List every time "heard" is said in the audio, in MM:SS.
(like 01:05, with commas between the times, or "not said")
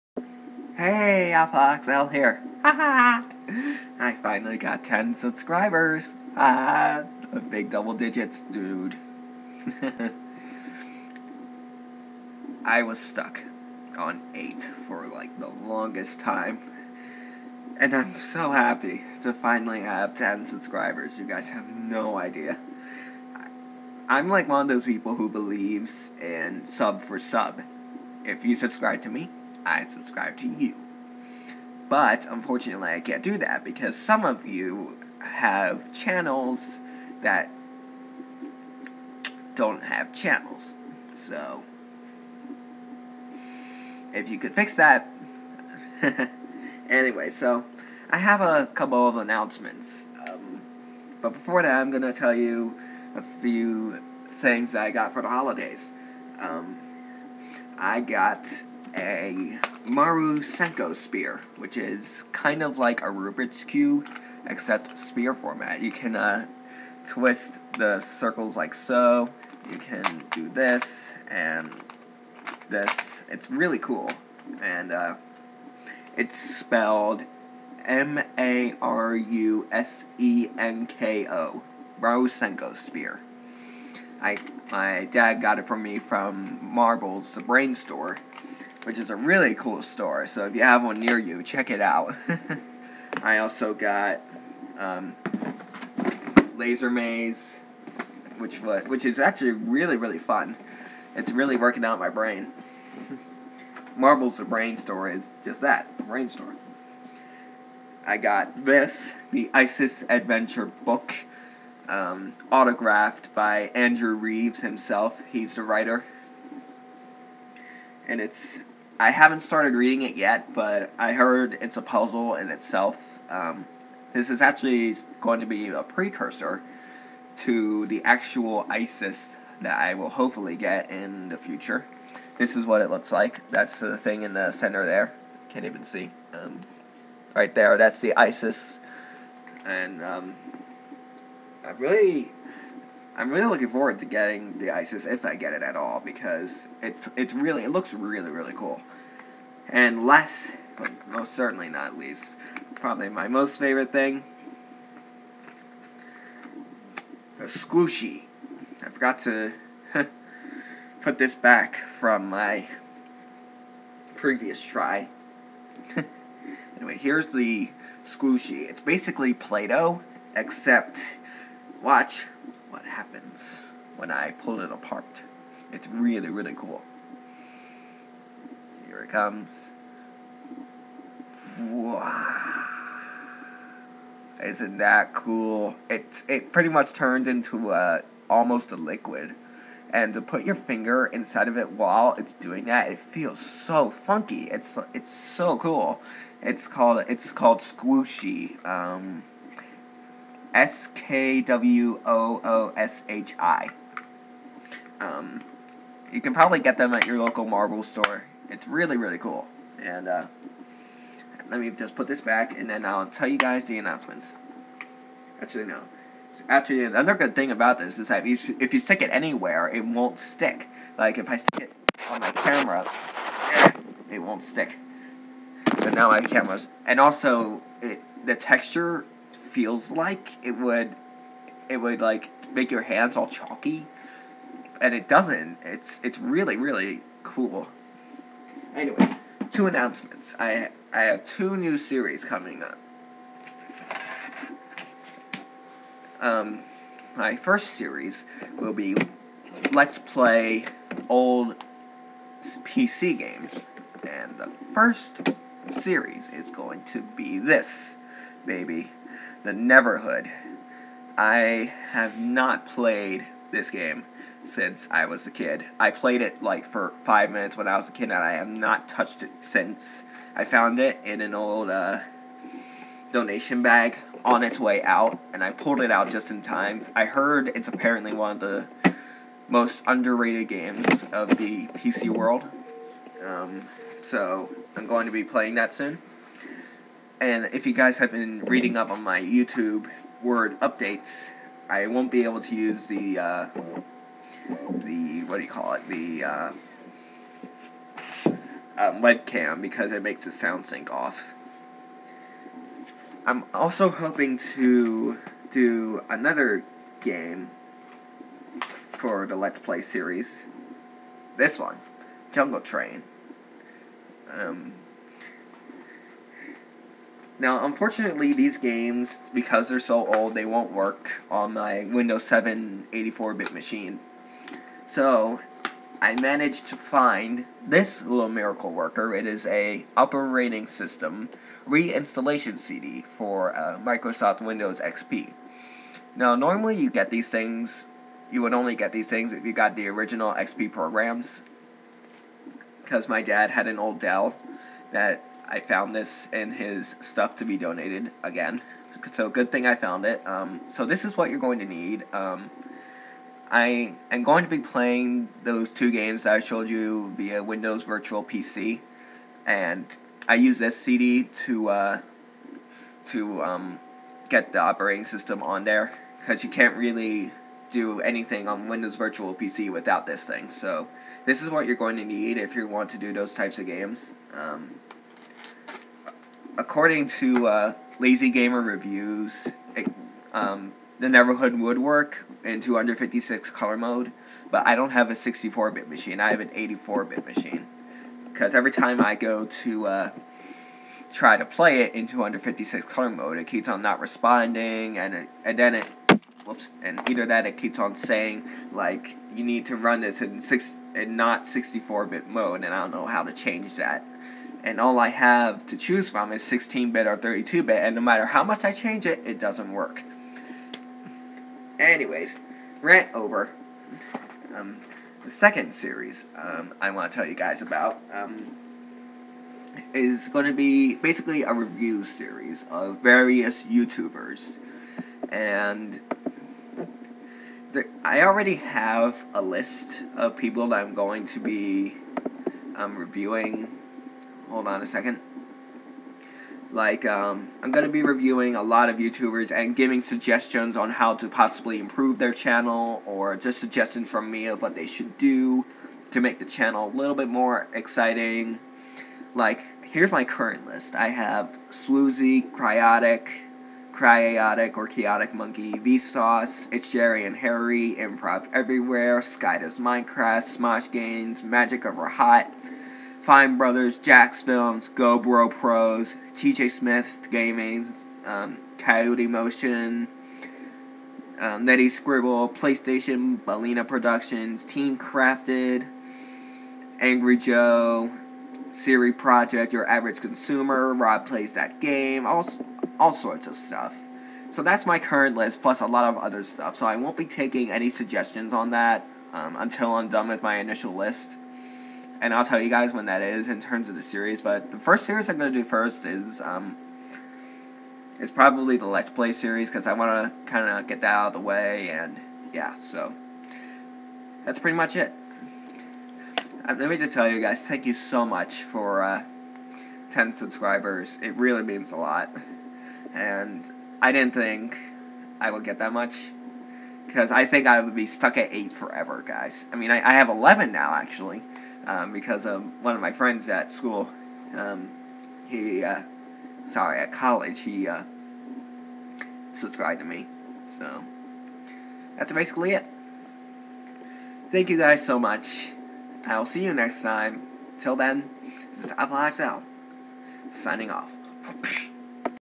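02:01, 04:37.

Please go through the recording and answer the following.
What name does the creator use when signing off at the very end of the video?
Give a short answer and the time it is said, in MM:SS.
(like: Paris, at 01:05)
Apple XL, at 08:58.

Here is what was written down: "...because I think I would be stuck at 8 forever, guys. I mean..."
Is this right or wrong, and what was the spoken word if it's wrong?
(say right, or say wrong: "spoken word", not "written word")
right.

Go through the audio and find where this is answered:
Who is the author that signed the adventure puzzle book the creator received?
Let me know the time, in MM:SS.
01:53.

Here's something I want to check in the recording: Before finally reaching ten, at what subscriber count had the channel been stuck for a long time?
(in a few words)
8.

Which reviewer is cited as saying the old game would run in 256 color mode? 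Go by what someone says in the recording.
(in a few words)
Lazy Game Reviews.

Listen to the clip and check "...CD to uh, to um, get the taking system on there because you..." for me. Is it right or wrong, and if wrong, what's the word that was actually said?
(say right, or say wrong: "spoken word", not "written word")
wrong: "operating", not "taking".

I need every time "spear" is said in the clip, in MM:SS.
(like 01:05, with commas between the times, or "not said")
01:04.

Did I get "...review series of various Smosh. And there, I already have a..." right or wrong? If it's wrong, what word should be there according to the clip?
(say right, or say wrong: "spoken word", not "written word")
wrong: "YouTubers", not "Smosh".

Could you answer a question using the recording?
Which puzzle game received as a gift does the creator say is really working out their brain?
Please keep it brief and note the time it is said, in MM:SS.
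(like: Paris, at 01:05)
Laser Maze, at 01:36.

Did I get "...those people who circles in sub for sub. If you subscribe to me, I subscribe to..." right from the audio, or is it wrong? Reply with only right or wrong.
wrong.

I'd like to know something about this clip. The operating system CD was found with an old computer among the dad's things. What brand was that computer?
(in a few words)
Dell.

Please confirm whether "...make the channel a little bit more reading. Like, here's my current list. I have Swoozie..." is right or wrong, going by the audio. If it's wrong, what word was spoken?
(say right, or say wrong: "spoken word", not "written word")
wrong: "exciting", not "reading".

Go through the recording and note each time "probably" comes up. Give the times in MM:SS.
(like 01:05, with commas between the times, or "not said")
02:32, 03:26, 08:18.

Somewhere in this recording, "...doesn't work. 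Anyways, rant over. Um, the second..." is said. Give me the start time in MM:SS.
06:49.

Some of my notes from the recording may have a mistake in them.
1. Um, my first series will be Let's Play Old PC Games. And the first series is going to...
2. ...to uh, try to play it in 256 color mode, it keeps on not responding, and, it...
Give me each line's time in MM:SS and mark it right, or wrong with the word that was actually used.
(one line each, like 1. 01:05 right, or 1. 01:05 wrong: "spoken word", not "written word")
1. 04:06 right
2. 06:29 right.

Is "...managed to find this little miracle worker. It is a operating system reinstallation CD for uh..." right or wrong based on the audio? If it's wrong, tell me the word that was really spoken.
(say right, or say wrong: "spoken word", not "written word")
right.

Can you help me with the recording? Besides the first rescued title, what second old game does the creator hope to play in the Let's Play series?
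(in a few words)
Jungle Train.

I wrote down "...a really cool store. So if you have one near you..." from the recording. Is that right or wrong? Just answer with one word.
right.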